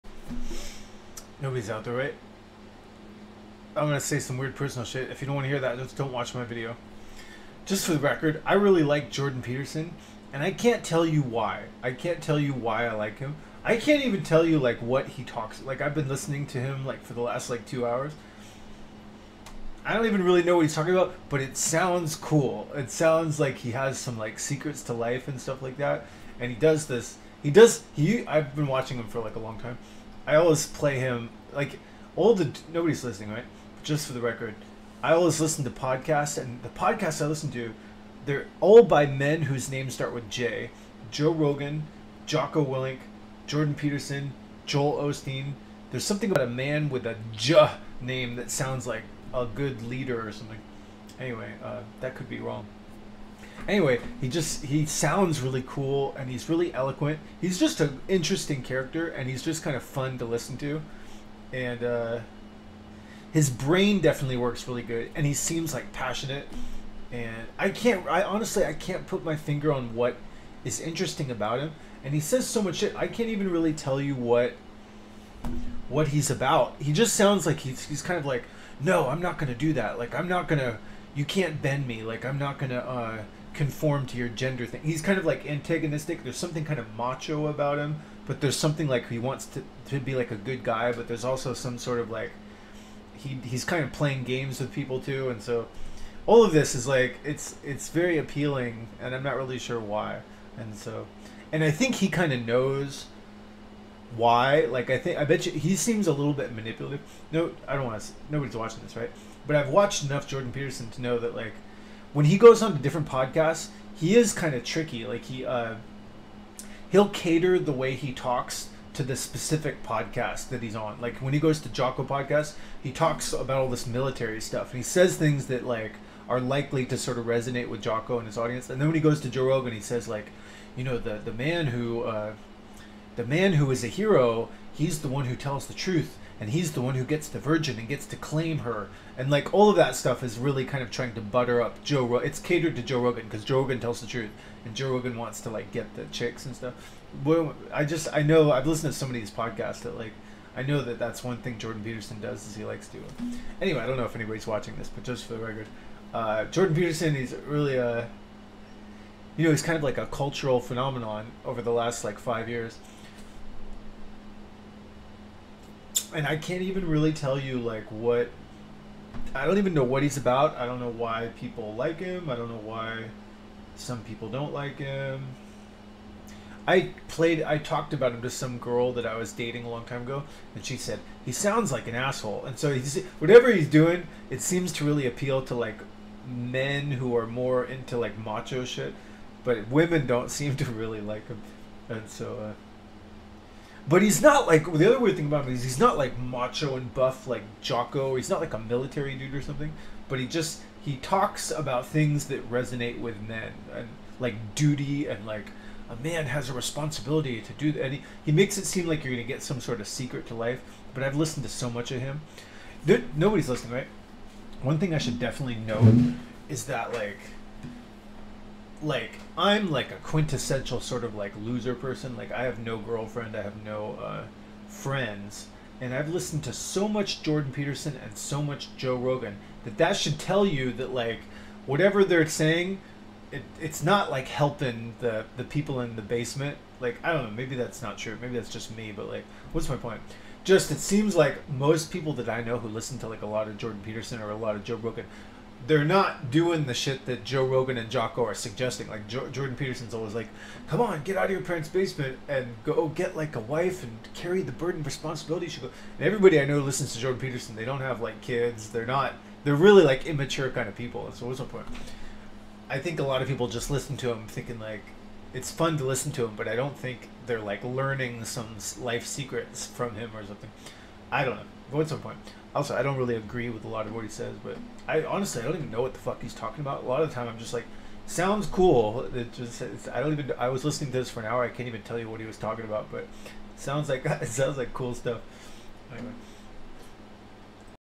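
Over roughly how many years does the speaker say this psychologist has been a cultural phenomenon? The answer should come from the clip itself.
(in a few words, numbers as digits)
5 years.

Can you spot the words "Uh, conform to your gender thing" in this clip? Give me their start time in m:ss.
1:22.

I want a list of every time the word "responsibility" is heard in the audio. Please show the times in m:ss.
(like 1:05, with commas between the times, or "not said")
3:26, 4:14.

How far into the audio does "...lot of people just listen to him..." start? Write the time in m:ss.
4:23.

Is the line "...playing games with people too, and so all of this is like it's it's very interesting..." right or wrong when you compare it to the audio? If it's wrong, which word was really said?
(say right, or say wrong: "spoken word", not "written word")
wrong: "appealing", not "interesting".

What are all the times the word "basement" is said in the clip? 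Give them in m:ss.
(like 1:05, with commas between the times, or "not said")
3:56, 4:11.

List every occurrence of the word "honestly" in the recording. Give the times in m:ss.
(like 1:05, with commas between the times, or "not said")
1:08, 4:35.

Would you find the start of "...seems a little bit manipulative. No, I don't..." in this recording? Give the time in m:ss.
1:45.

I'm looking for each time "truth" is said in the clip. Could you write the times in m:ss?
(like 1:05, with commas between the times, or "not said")
2:15, 2:24.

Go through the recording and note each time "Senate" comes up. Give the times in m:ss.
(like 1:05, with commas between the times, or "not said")
not said.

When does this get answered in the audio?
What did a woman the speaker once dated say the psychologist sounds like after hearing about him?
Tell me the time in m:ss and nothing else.
3:01.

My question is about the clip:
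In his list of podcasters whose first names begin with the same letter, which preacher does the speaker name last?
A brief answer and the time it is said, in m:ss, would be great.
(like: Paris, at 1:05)
Joel Osteen, at 0:44.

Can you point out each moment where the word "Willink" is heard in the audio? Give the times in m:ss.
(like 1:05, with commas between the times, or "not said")
0:42.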